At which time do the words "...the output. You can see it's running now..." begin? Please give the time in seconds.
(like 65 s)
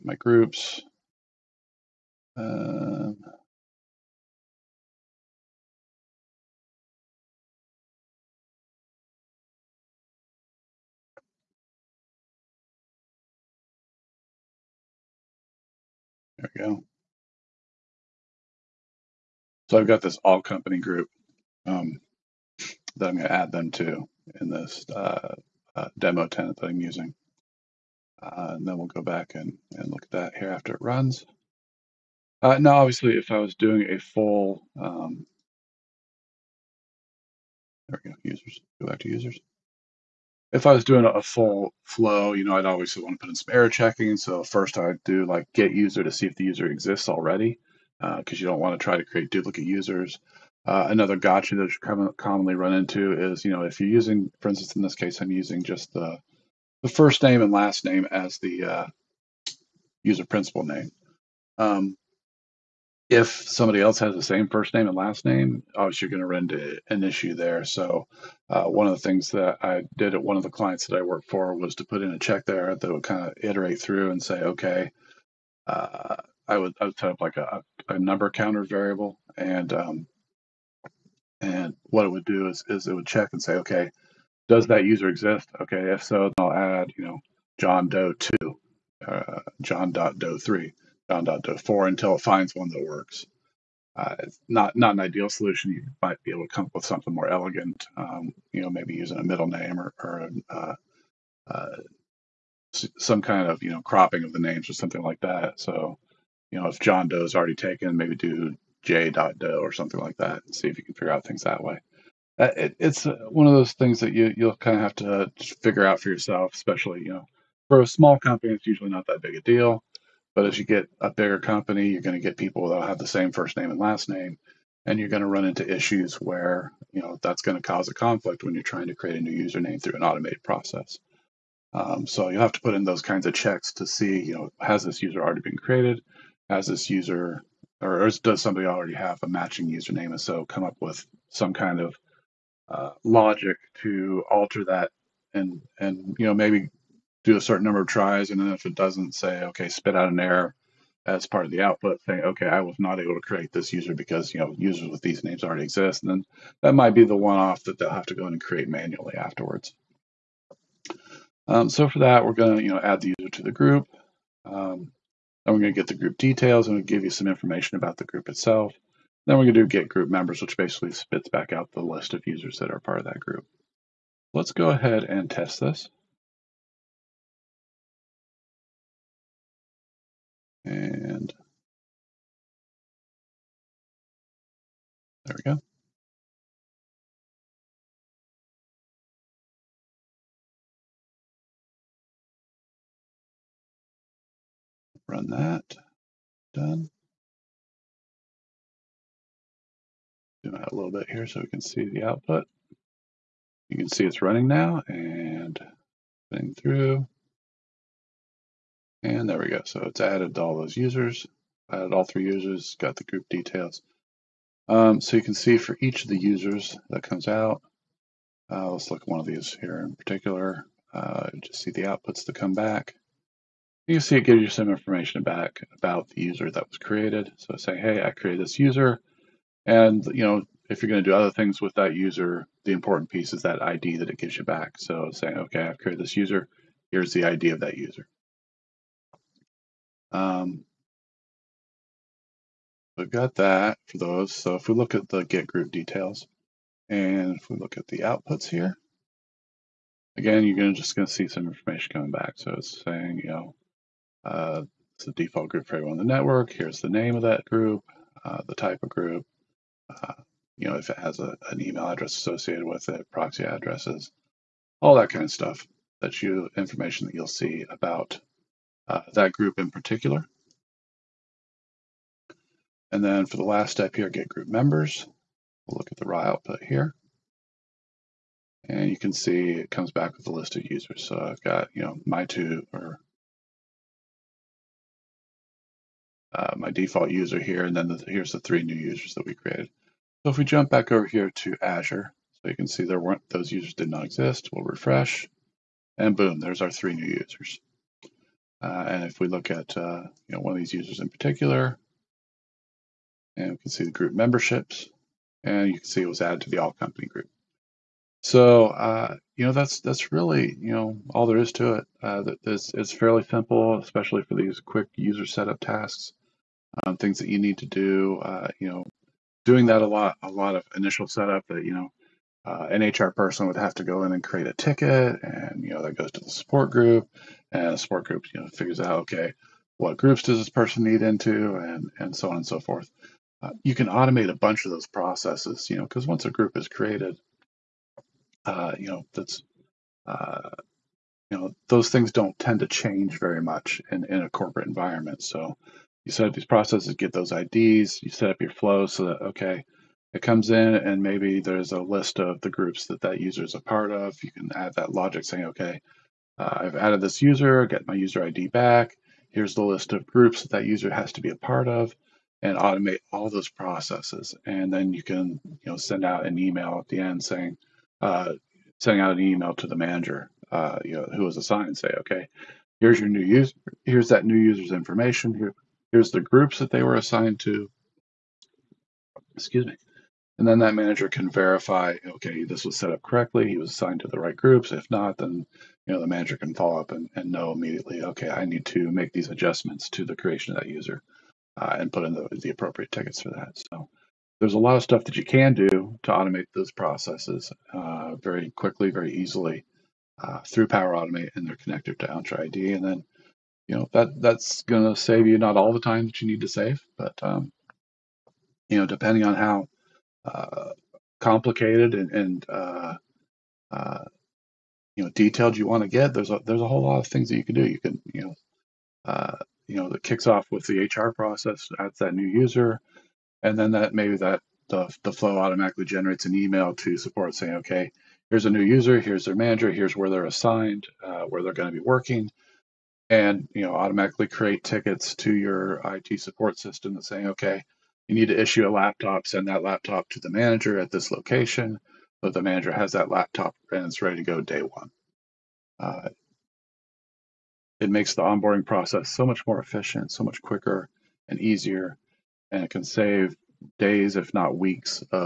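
201 s.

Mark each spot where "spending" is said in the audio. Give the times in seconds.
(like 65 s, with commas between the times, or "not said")
not said.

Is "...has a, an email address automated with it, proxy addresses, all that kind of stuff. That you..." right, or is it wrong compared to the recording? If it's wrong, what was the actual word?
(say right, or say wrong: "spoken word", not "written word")
wrong: "associated", not "automated".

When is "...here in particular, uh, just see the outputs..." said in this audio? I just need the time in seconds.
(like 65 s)
219 s.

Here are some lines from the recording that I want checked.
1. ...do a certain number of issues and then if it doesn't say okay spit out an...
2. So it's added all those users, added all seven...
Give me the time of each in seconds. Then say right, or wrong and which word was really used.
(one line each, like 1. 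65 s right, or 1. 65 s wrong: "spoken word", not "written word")
1. 147 s wrong: "tries", not "issues"
2. 209 s wrong: "three", not "seven".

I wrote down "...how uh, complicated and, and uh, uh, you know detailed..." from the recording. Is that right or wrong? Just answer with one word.
right.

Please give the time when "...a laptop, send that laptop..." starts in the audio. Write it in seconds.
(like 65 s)
438 s.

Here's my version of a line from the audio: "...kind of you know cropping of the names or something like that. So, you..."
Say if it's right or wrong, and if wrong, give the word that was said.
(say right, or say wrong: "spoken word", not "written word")
right.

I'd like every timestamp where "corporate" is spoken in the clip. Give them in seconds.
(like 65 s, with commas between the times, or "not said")
344 s.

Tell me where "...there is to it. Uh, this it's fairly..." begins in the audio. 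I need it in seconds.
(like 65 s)
311 s.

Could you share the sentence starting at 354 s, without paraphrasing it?
You can add that logic saying, okay, uh, I've added this user, get my user ID back.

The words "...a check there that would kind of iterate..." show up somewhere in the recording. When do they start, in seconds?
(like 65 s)
72 s.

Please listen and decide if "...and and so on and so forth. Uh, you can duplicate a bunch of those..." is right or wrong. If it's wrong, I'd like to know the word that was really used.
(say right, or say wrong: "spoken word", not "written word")
wrong: "automate", not "duplicate".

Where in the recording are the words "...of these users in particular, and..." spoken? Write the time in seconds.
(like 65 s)
300 s.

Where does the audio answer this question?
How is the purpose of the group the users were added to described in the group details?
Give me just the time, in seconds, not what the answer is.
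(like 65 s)
255 s.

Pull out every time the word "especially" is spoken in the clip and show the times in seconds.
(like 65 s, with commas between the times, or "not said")
116 s, 313 s.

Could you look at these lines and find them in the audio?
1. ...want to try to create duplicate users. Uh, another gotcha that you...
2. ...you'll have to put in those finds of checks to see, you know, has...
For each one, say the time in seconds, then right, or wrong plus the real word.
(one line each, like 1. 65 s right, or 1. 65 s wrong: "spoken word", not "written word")
1. 48 s right
2. 132 s wrong: "kinds", not "finds".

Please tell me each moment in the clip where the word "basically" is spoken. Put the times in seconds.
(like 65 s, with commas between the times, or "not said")
170 s.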